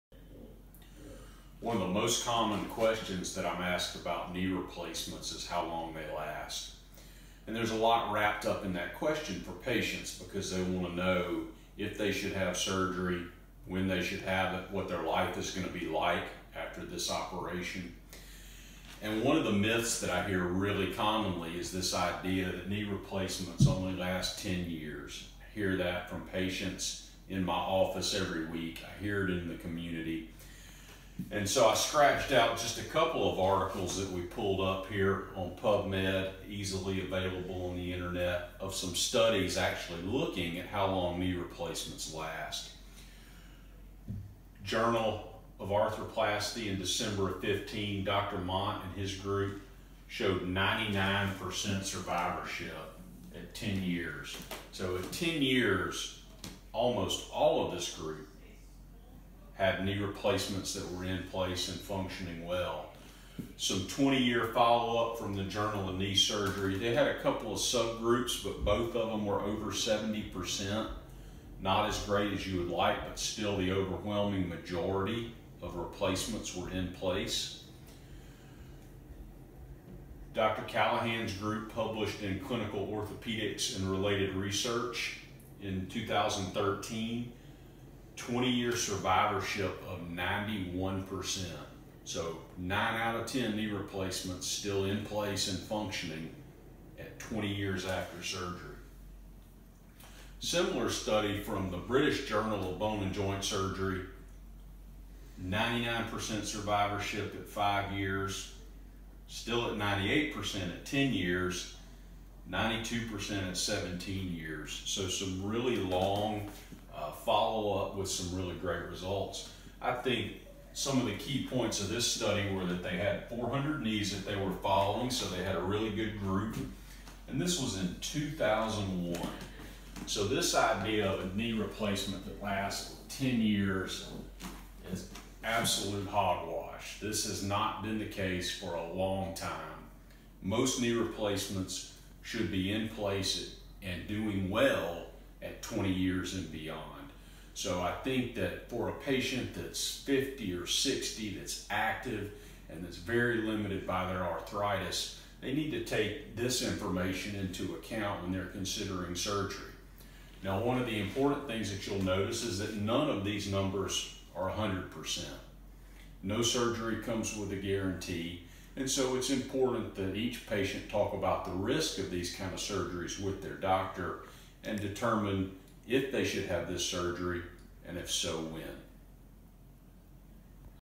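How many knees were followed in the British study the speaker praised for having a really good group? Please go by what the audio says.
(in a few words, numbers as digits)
400.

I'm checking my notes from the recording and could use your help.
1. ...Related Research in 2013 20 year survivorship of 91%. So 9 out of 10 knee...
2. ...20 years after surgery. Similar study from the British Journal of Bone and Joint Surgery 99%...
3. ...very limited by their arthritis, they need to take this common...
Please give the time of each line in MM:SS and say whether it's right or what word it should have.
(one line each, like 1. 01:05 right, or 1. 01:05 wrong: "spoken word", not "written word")
1. 01:23 right
2. 01:37 right
3. 02:32 wrong: "information", not "common".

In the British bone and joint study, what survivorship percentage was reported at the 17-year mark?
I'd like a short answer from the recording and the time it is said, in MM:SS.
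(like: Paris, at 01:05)
92%, at 01:52.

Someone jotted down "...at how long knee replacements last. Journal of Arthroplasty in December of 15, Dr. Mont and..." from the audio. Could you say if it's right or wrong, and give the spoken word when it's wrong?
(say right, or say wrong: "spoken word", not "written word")
right.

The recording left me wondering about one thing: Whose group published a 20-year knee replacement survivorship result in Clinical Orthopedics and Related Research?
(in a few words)
Dr. Callaghan.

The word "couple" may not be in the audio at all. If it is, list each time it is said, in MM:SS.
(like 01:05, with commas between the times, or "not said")
00:32, 01:07.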